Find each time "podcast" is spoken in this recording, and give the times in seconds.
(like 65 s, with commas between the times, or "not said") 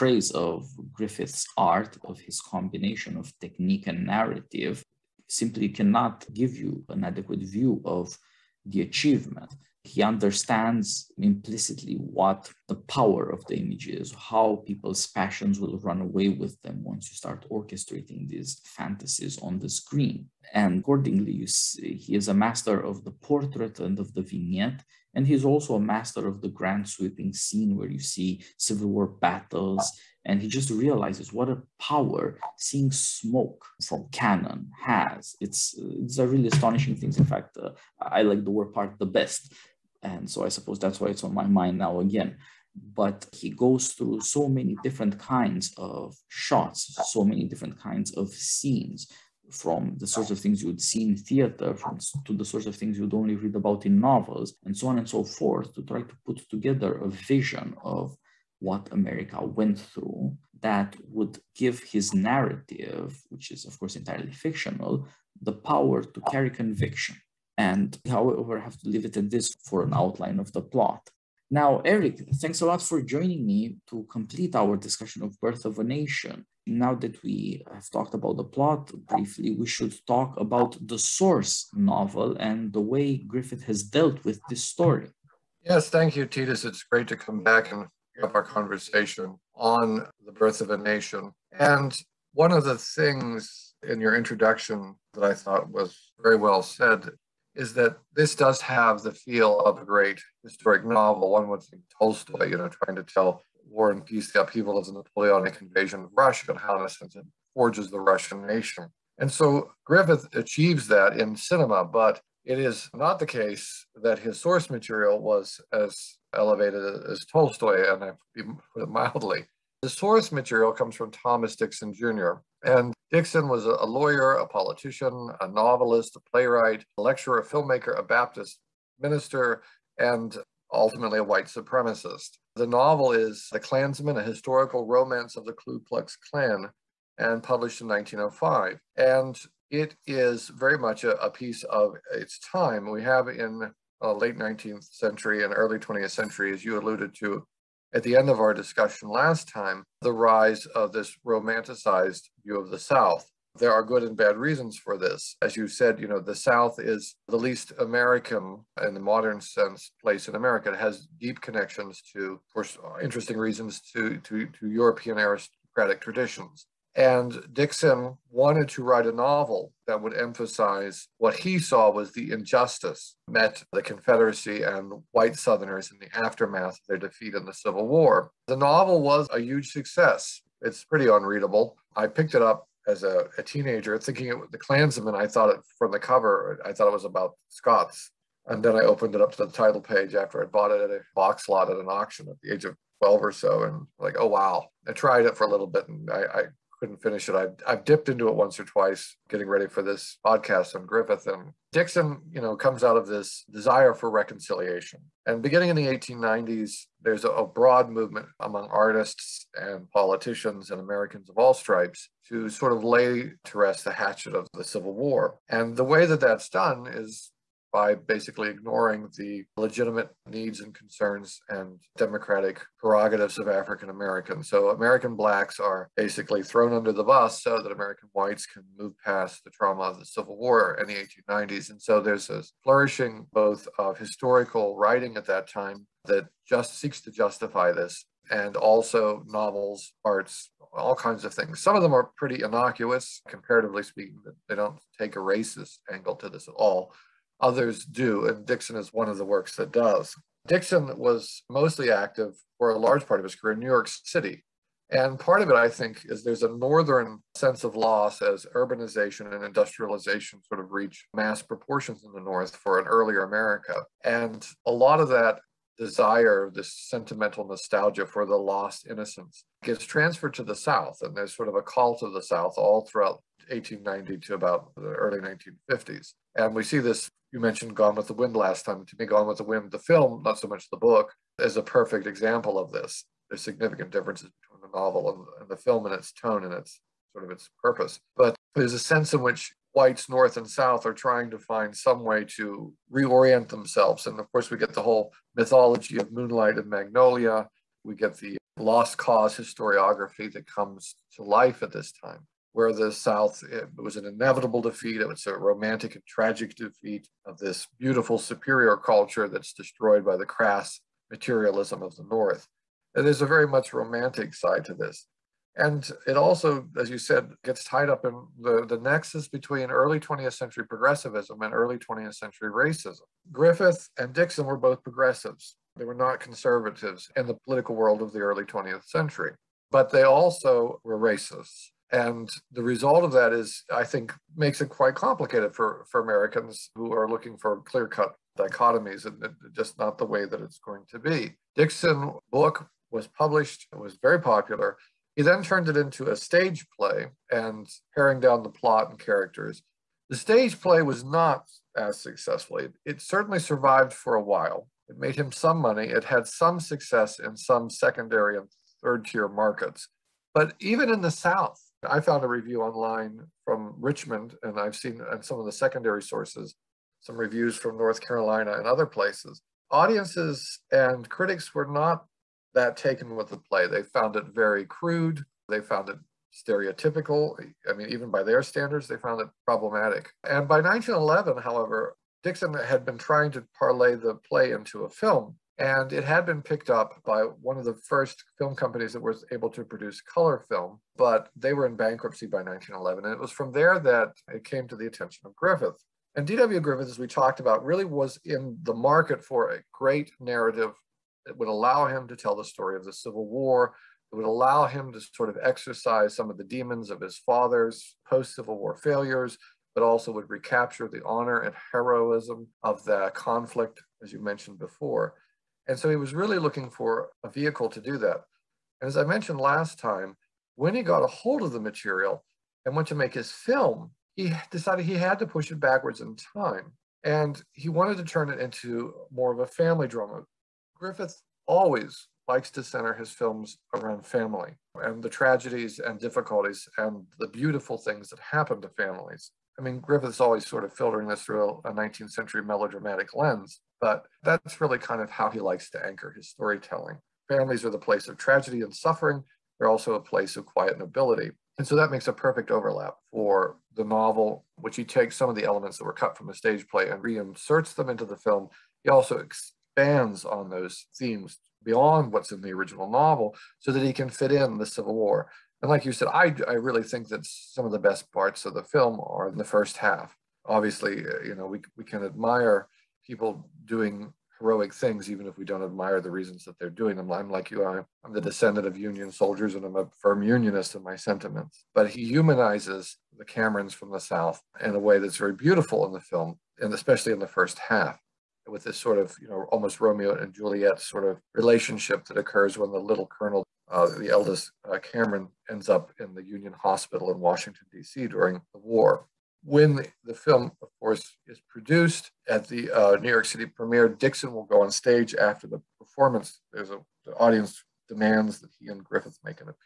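200 s.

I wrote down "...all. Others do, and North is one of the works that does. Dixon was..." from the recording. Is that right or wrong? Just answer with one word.
wrong.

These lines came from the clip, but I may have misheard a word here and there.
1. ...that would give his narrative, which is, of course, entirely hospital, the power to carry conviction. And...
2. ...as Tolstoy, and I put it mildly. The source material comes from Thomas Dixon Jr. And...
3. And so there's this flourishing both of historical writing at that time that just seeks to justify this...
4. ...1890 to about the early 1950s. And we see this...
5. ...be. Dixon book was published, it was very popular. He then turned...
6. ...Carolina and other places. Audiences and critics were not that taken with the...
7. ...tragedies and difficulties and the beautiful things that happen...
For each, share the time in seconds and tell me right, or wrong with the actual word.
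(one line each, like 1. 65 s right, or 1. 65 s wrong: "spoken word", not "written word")
1. 60 s wrong: "fictional", not "hospital"
2. 117 s right
3. 231 s right
4. 273 s right
5. 340 s right
6. 368 s right
7. 435 s right.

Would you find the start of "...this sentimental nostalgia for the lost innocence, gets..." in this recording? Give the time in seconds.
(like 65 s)
266 s.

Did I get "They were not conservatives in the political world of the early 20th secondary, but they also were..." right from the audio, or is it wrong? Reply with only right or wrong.
wrong.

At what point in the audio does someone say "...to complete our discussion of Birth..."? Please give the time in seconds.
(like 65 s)
73 s.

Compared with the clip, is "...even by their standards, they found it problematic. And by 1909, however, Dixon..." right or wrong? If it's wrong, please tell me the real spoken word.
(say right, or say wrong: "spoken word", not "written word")
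wrong: "1911", not "1909".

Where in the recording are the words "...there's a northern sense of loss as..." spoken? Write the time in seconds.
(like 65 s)
256 s.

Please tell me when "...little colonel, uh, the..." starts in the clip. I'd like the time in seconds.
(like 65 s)
492 s.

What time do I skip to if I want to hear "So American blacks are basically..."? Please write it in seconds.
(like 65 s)
224 s.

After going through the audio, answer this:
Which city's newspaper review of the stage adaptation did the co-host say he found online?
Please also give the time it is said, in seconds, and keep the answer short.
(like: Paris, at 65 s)
Richmond, at 363 s.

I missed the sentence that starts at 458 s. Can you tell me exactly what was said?
He also expands on those themes beyond what's in the original novel so that he can fit in the Civil War.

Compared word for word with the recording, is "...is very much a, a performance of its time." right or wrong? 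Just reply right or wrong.
wrong.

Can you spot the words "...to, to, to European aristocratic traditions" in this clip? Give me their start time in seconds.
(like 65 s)
163 s.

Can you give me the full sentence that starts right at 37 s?
In fact, uh, I like the war part the best and so I suppose that's why it's on my mind now again.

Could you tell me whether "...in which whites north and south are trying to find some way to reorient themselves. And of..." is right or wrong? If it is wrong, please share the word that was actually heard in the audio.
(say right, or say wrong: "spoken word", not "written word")
right.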